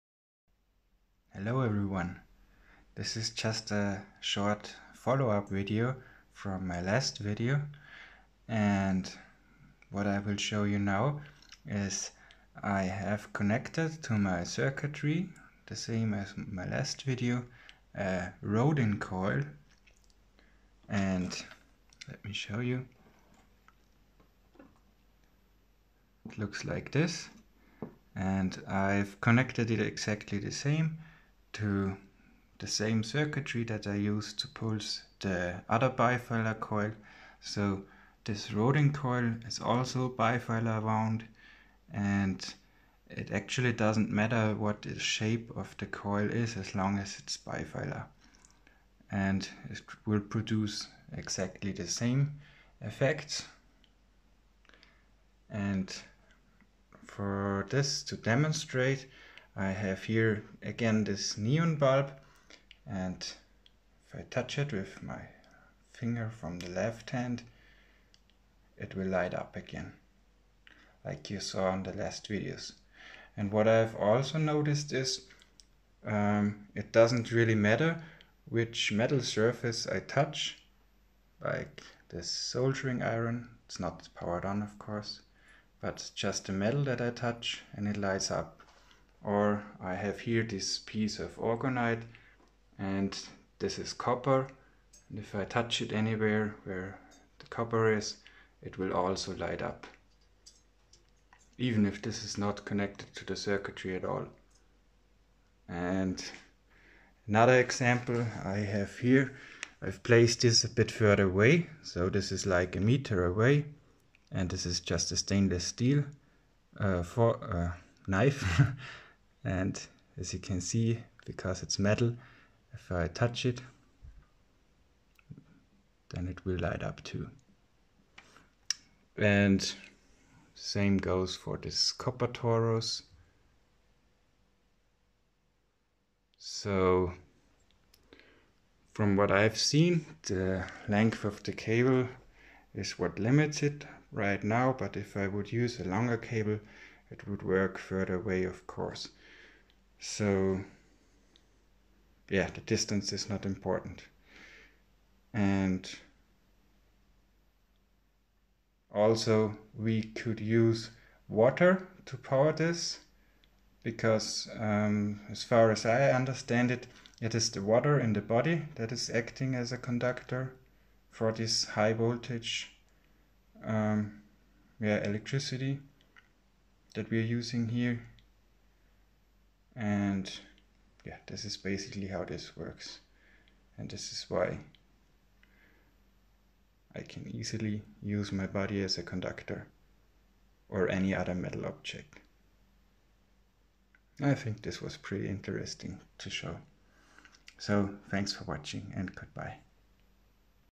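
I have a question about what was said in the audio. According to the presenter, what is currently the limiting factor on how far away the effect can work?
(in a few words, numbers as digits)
The length of the cable.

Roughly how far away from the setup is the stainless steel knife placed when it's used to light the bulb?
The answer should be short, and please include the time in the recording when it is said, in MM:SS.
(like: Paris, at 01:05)
A meter, at 01:52.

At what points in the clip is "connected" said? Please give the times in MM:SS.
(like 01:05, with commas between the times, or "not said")
00:13, 00:29, 01:42.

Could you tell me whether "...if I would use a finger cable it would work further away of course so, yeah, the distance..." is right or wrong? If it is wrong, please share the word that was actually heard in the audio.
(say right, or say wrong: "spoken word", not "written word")
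wrong: "longer", not "finger".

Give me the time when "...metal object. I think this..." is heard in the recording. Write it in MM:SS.
03:11.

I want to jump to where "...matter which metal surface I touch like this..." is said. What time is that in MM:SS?
01:17.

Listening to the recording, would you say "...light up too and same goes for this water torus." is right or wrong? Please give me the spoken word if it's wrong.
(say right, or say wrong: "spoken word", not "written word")
wrong: "copper", not "water".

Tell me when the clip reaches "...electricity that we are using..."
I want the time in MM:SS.
02:55.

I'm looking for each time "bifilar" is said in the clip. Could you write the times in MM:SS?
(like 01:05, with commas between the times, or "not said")
00:35, 00:40, 00:47.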